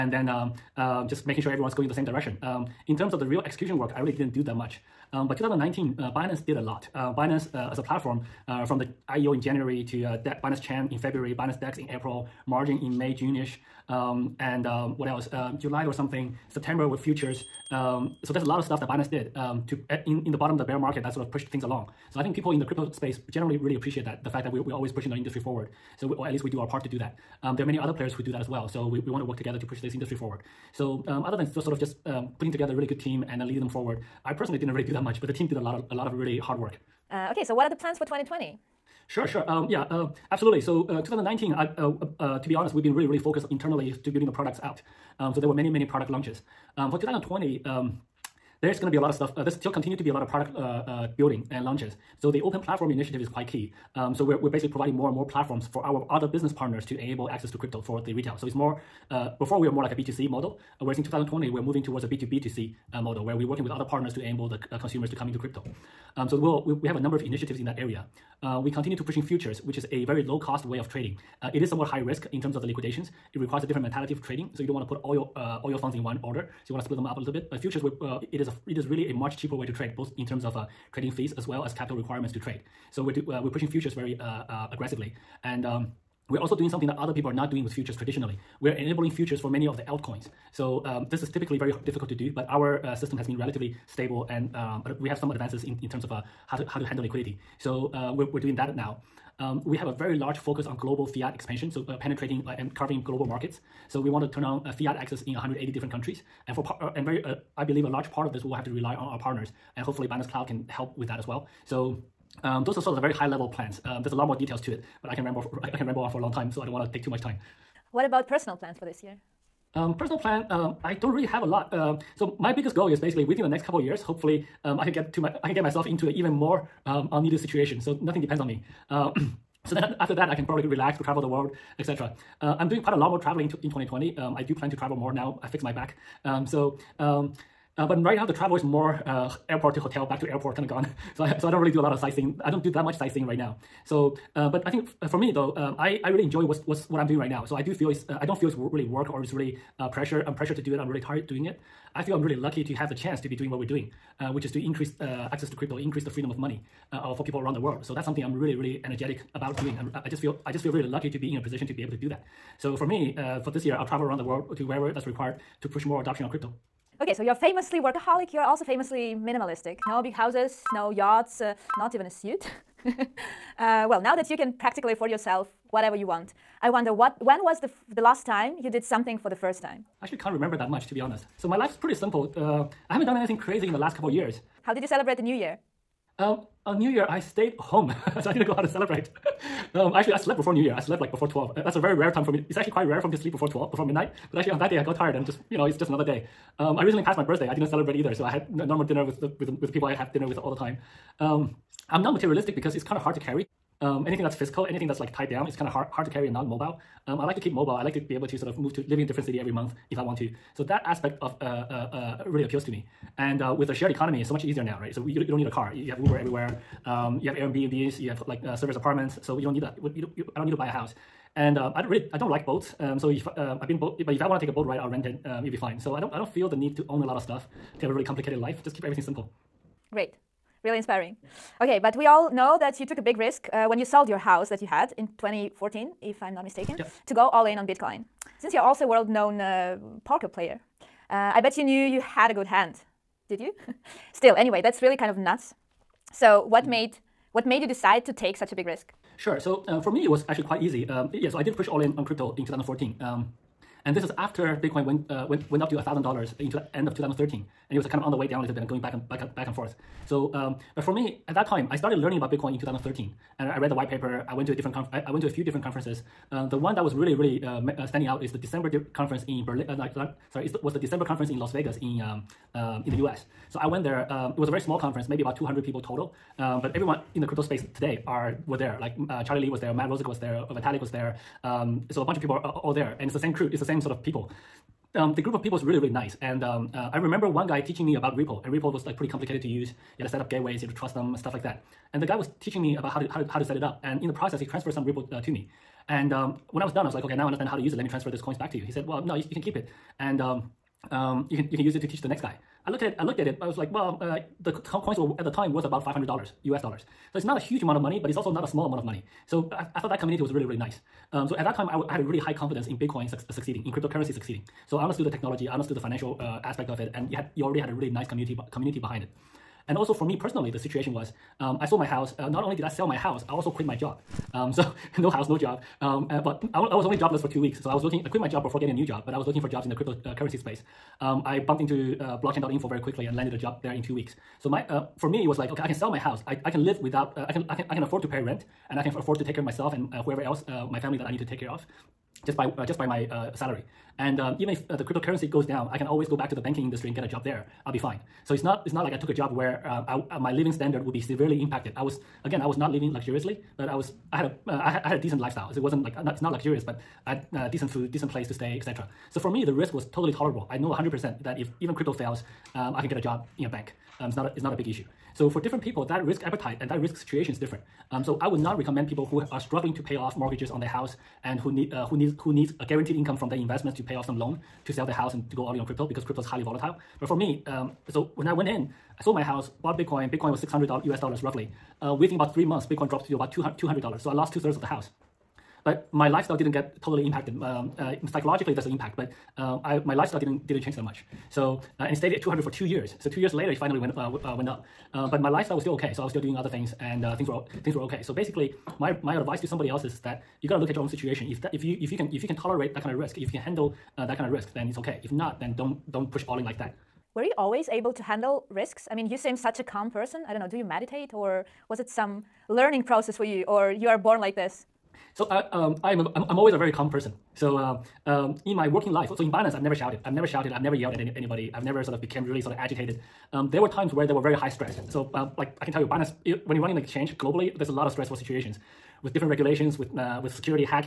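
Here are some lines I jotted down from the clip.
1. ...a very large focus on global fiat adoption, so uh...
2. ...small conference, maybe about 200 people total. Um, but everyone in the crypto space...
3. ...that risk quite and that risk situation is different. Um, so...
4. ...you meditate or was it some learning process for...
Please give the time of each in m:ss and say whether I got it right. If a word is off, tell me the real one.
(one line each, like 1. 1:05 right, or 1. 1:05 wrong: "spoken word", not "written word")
1. 1:39 wrong: "expansion", not "adoption"
2. 4:34 right
3. 6:05 wrong: "appetite", not "quite"
4. 6:50 right.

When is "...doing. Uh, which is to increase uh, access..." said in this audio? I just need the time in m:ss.
2:33.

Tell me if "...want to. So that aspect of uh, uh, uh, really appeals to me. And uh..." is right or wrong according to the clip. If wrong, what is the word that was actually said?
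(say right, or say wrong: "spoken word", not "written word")
right.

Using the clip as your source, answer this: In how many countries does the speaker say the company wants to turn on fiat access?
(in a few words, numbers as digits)
180.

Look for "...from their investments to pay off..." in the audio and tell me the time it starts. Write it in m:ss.
6:13.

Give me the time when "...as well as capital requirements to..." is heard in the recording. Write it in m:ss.
1:21.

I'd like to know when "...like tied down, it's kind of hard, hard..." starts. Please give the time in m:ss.
3:25.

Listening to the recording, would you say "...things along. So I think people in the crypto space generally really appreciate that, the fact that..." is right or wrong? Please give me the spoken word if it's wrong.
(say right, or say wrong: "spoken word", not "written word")
right.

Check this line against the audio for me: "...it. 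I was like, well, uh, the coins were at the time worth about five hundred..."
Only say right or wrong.
right.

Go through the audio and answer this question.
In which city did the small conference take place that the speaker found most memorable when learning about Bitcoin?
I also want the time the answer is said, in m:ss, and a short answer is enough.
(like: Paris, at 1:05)
Las Vegas, at 4:31.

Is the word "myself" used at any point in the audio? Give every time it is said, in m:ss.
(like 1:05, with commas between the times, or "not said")
2:05, 5:39.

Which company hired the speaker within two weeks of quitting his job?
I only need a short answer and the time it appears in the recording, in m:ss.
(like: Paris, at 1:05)
blockchain.info, at 5:32.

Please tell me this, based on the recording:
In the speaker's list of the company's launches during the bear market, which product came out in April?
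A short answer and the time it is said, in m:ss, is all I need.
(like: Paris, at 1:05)
Binance DEX, at 0:11.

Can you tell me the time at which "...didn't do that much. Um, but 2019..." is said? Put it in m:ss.
0:04.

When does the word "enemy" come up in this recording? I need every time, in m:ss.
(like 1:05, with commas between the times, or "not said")
not said.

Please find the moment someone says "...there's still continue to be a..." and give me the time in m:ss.
0:49.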